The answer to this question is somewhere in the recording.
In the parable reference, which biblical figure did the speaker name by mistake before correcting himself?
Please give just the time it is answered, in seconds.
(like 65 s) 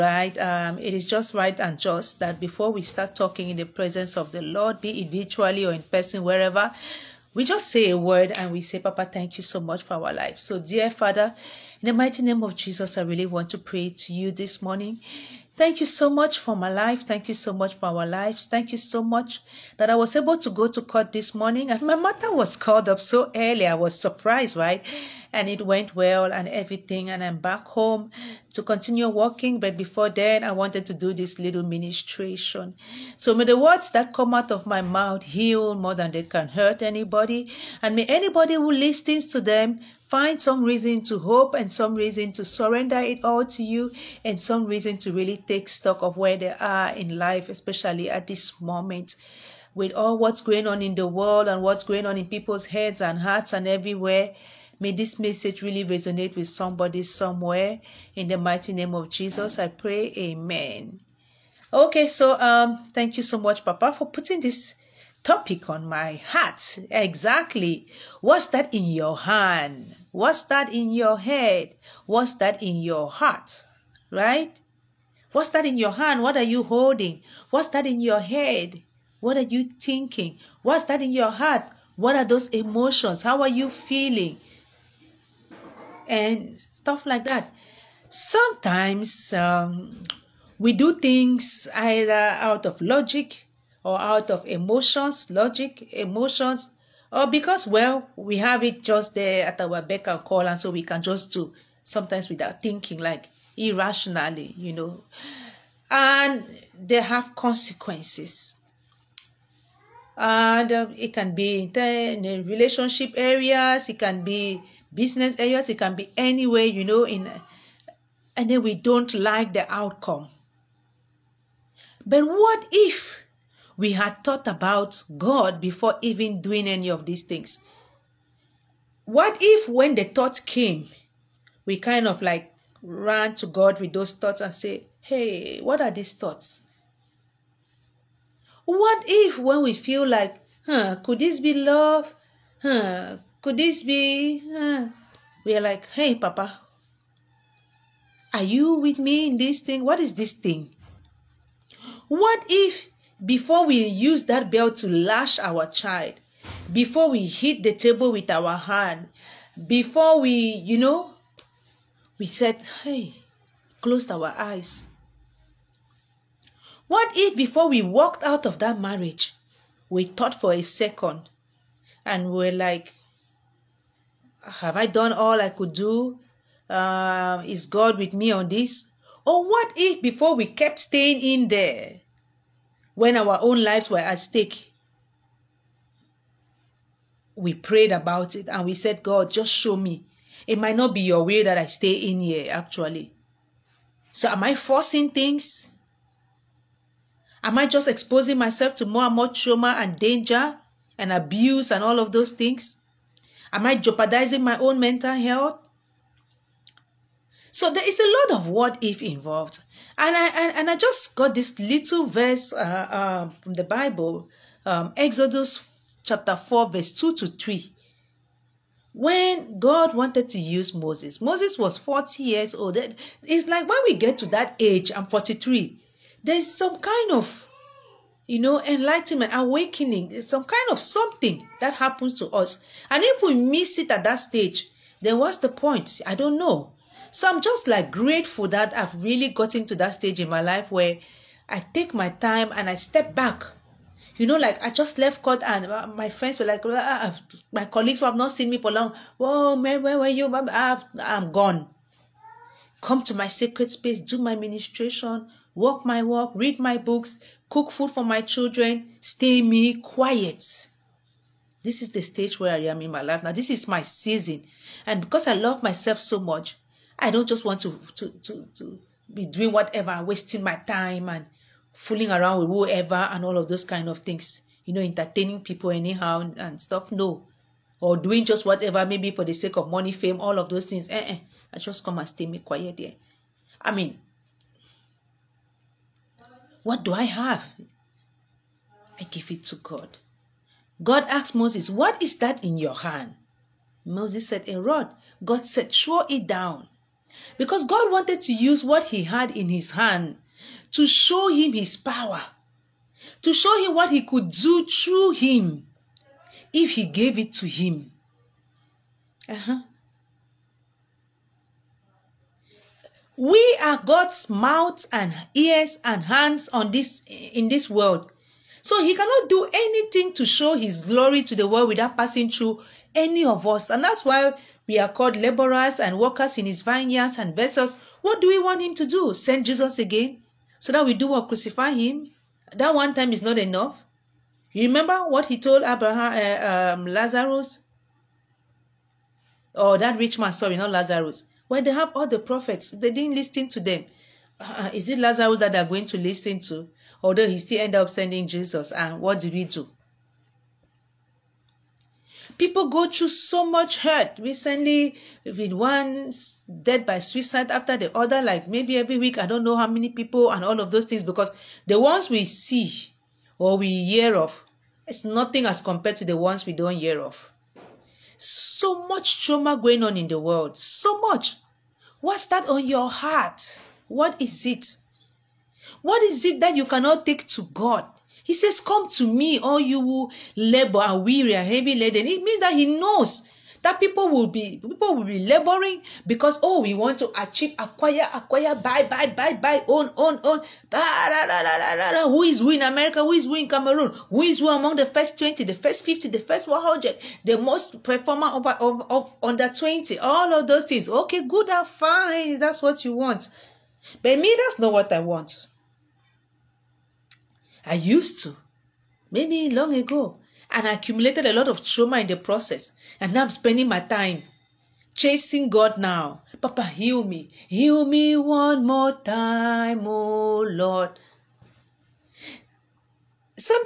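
335 s.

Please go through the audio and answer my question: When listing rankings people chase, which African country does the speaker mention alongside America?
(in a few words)
Cameroon.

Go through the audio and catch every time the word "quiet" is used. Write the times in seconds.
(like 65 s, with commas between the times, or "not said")
259 s, 282 s.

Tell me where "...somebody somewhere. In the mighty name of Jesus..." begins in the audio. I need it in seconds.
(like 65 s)
56 s.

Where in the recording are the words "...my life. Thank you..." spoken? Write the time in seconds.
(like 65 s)
16 s.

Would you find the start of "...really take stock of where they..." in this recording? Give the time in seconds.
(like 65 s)
45 s.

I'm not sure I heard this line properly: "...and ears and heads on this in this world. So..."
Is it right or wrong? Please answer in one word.
wrong.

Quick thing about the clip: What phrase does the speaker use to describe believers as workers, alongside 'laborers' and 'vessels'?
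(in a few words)
Workers in his vineyards.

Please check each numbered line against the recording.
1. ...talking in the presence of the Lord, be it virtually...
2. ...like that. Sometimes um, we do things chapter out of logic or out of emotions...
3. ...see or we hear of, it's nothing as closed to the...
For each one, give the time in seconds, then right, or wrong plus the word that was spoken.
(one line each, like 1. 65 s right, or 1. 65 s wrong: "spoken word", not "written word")
1. 3 s right
2. 87 s wrong: "either", not "chapter"
3. 362 s wrong: "compared", not "closed".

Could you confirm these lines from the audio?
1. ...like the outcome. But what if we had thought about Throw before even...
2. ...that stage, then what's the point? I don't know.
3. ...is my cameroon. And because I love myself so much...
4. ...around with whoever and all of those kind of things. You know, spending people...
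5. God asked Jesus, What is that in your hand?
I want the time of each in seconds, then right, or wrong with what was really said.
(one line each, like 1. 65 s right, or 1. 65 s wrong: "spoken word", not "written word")
1. 119 s wrong: "God", not "Throw"
2. 234 s right
3. 263 s wrong: "season", not "cameroon"
4. 272 s wrong: "entertaining", not "spending"
5. 290 s wrong: "Moses", not "Jesus".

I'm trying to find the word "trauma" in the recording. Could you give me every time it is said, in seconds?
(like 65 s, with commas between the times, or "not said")
199 s, 369 s, 411 s.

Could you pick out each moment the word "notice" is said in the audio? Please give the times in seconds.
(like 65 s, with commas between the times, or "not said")
not said.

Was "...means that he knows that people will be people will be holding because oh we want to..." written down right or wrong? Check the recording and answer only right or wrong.
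wrong.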